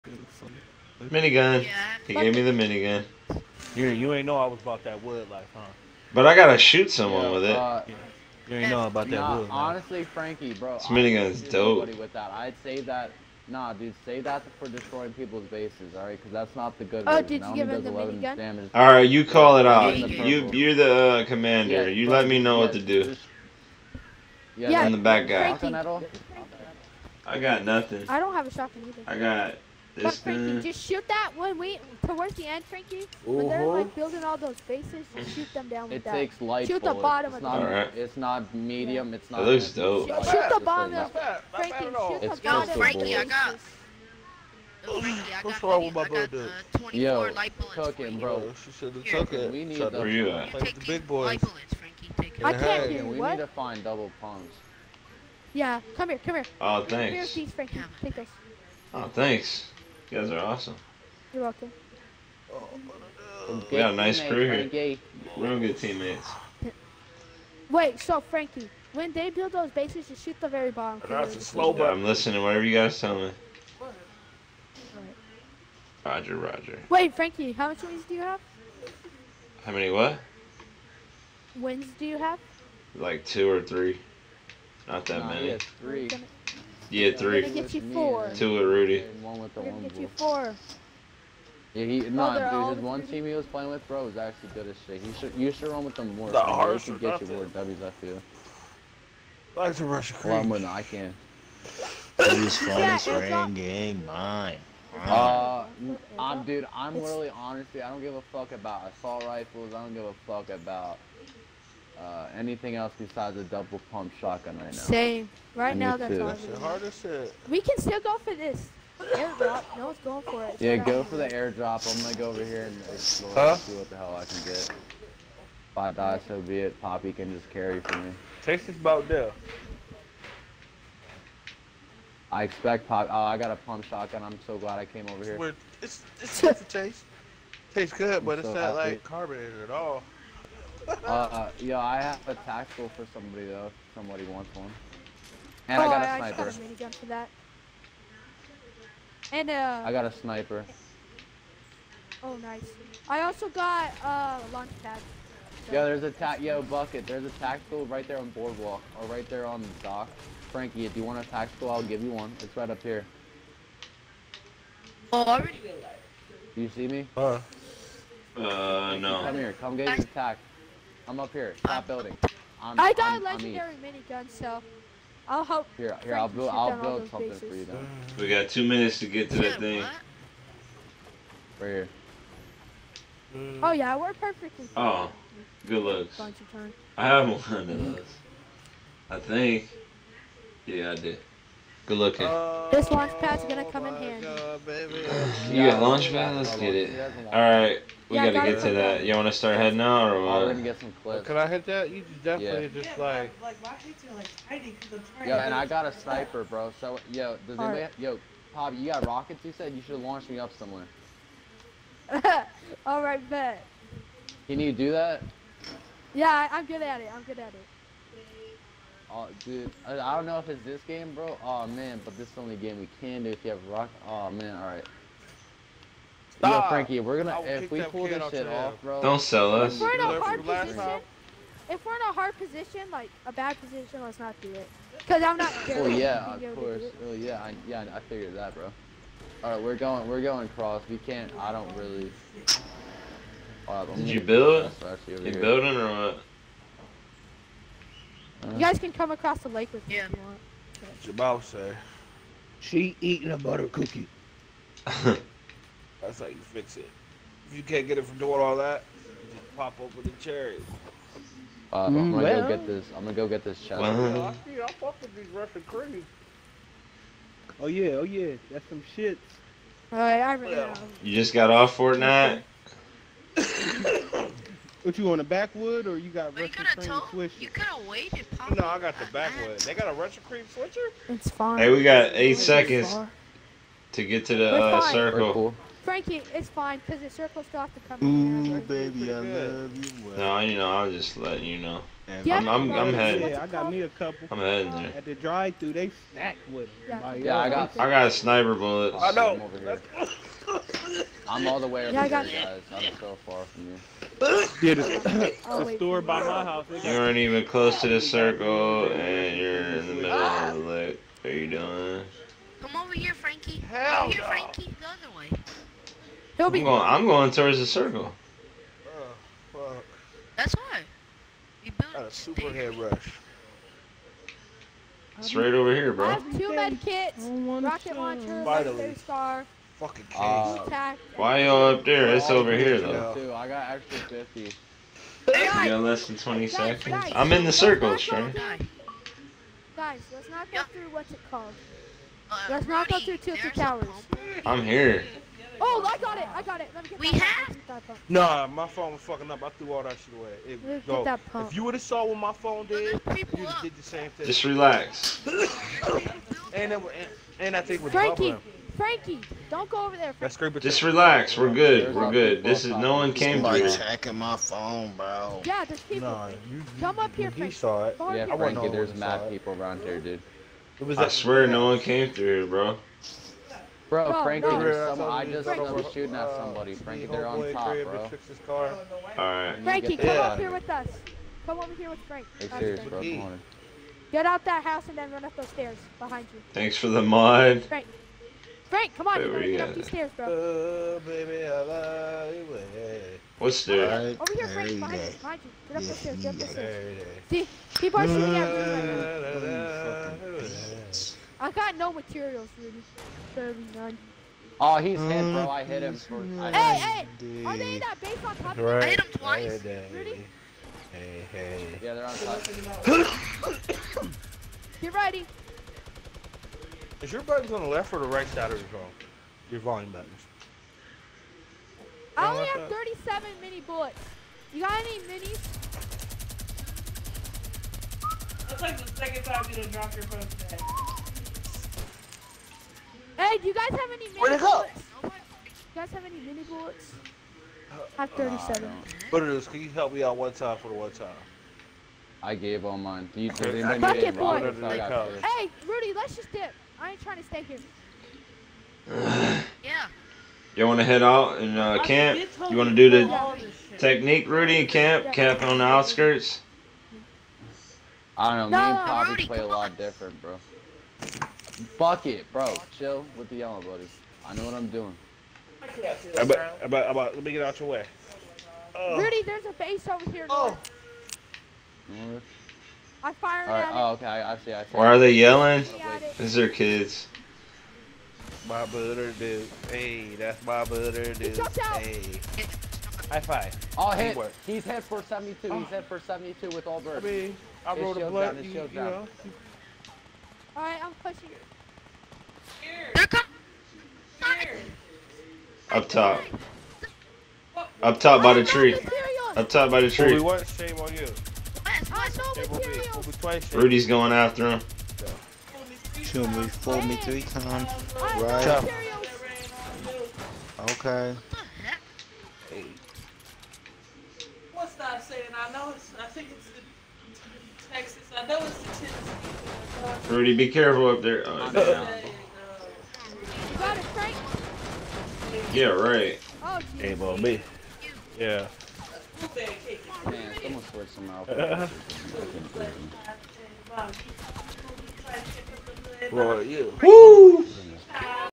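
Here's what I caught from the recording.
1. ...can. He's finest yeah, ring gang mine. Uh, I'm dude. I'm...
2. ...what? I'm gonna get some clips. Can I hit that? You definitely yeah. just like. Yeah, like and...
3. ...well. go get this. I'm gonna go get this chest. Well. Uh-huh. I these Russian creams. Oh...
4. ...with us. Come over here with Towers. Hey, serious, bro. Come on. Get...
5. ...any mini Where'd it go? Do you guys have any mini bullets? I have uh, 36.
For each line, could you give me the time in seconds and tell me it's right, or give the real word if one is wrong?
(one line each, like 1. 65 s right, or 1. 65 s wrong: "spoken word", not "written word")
1. 100 s right
2. 200 s right
3. 262 s right
4. 380 s wrong: "Frank", not "Towers"
5. 433 s wrong: "37", not "36".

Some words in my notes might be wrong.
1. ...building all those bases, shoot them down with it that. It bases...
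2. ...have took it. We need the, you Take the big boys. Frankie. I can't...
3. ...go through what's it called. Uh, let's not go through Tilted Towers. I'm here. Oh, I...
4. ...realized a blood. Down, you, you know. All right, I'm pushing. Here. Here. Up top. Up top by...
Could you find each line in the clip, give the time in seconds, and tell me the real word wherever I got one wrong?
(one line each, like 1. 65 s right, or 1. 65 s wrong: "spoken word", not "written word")
1. 33 s wrong: "takes", not "bases"
2. 48 s right
3. 340 s right
4. 487 s wrong: "rolled", not "realized".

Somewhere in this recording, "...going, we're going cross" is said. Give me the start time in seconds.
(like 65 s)
239 s.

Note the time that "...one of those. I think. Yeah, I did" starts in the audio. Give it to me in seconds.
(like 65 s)
187 s.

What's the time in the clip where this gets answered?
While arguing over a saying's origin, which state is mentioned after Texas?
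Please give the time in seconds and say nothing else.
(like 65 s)
518 s.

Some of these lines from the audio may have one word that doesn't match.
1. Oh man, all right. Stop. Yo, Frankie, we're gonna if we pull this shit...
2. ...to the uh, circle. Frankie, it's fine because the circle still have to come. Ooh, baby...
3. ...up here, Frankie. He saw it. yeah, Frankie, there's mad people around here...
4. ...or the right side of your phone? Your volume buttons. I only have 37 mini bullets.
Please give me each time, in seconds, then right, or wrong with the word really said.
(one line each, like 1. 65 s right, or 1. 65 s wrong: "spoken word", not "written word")
1. 224 s right
2. 284 s right
3. 366 s right
4. 417 s right.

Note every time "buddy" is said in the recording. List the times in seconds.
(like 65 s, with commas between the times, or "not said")
463 s.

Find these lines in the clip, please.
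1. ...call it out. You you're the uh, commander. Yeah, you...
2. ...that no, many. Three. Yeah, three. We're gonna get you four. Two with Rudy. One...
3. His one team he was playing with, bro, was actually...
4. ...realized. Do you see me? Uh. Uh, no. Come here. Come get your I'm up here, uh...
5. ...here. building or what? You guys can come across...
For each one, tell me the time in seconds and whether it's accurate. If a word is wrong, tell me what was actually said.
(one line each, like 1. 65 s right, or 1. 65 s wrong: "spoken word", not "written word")
1. 19 s right
2. 85 s right
3. 92 s right
4. 165 s right
5. 245 s right.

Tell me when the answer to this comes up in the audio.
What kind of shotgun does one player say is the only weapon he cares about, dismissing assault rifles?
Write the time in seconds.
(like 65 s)
113 s.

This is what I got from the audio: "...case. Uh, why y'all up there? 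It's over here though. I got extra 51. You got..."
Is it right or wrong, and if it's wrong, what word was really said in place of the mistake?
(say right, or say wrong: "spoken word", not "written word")
wrong: "50", not "51".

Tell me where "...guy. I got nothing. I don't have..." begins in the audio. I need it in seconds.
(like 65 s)
25 s.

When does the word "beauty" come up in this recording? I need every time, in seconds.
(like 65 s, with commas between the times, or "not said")
not said.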